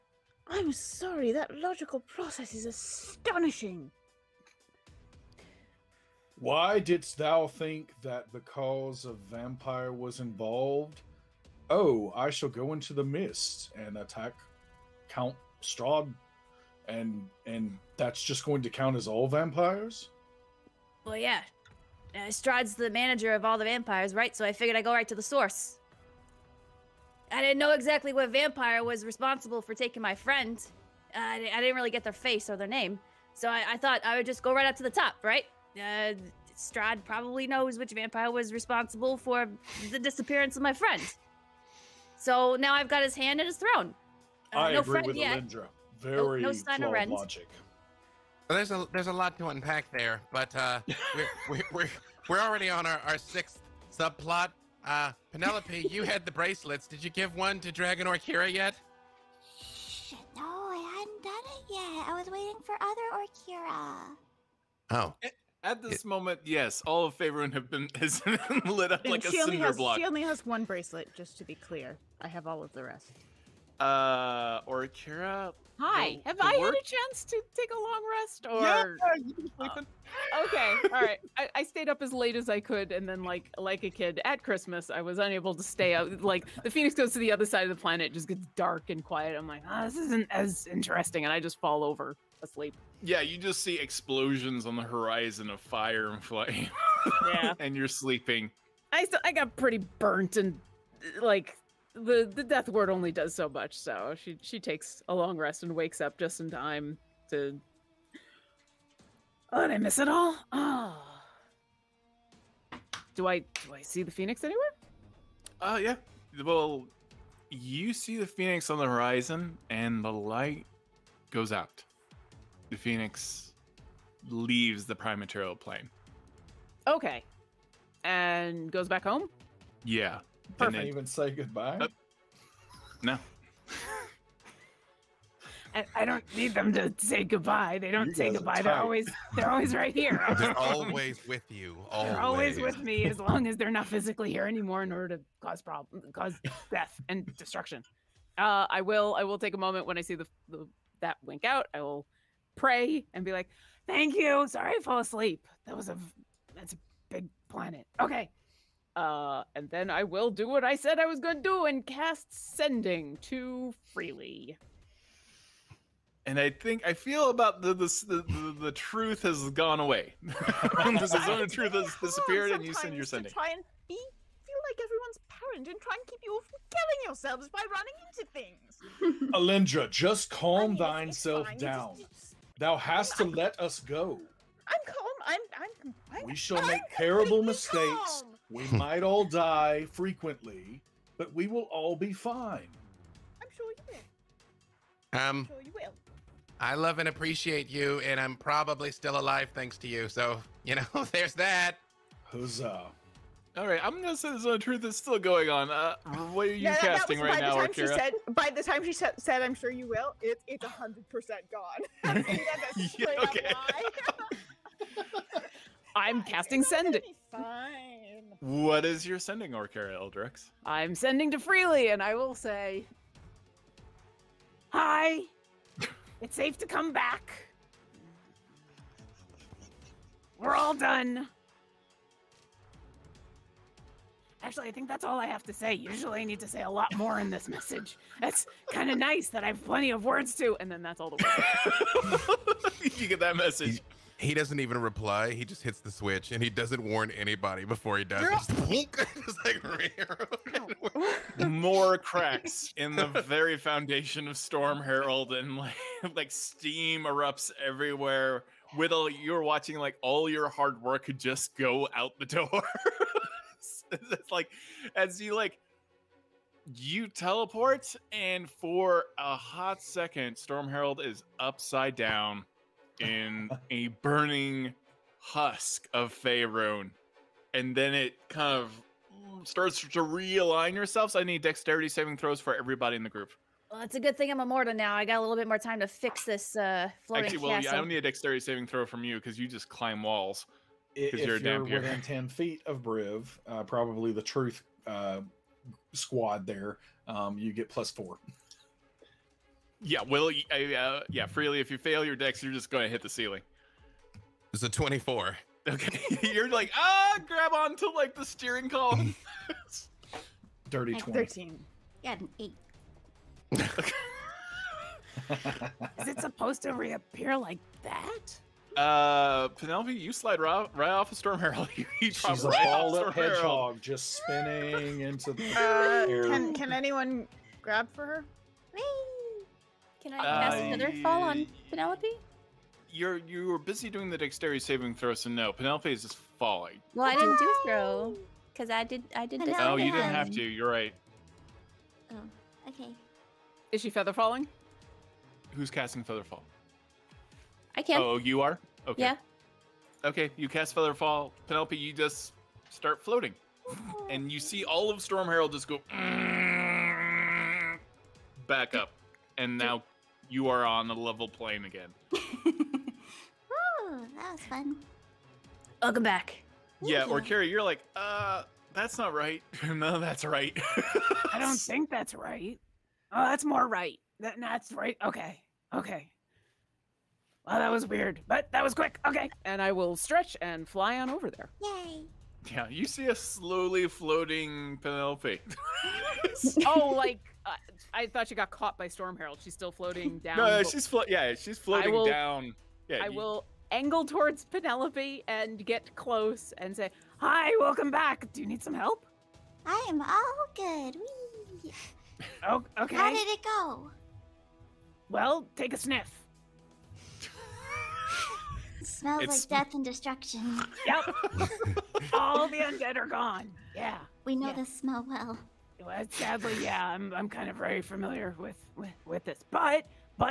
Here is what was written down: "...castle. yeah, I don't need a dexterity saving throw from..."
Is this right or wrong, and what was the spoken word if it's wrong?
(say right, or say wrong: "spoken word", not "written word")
right.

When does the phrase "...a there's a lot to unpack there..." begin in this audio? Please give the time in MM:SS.
00:48.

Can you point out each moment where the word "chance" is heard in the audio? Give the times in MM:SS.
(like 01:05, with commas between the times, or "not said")
01:16.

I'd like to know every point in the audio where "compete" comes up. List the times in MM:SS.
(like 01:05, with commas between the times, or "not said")
not said.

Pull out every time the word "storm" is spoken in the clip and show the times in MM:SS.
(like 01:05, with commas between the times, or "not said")
04:14, 04:30, 05:21, 05:55, 06:28.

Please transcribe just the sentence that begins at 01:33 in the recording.
Yeah, you just see explosions on the horizon of fire and flame.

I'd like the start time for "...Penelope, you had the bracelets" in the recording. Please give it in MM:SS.
00:55.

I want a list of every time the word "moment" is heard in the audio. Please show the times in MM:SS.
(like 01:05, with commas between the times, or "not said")
01:06, 02:29.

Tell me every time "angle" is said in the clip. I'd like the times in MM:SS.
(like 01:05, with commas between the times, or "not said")
06:33.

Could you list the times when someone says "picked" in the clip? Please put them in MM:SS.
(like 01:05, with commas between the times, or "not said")
not said.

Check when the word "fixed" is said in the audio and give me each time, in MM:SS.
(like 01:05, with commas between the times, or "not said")
not said.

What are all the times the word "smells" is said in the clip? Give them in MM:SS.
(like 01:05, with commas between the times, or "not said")
06:49, 06:54.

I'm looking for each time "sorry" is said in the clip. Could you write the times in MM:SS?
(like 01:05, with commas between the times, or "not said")
00:00, 02:34.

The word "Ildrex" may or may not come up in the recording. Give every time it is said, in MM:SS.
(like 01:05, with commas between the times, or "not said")
03:39.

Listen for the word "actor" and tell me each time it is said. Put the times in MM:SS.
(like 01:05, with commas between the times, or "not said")
not said.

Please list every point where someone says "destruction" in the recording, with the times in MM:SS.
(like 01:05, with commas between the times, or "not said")
02:27, 06:49.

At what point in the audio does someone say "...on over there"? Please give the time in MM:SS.
06:20.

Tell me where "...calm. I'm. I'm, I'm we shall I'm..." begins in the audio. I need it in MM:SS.
03:04.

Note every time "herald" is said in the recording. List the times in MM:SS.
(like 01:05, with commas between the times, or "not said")
04:14, 04:30, 05:21, 05:55, 06:29.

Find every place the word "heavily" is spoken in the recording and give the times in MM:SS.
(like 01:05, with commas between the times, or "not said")
not said.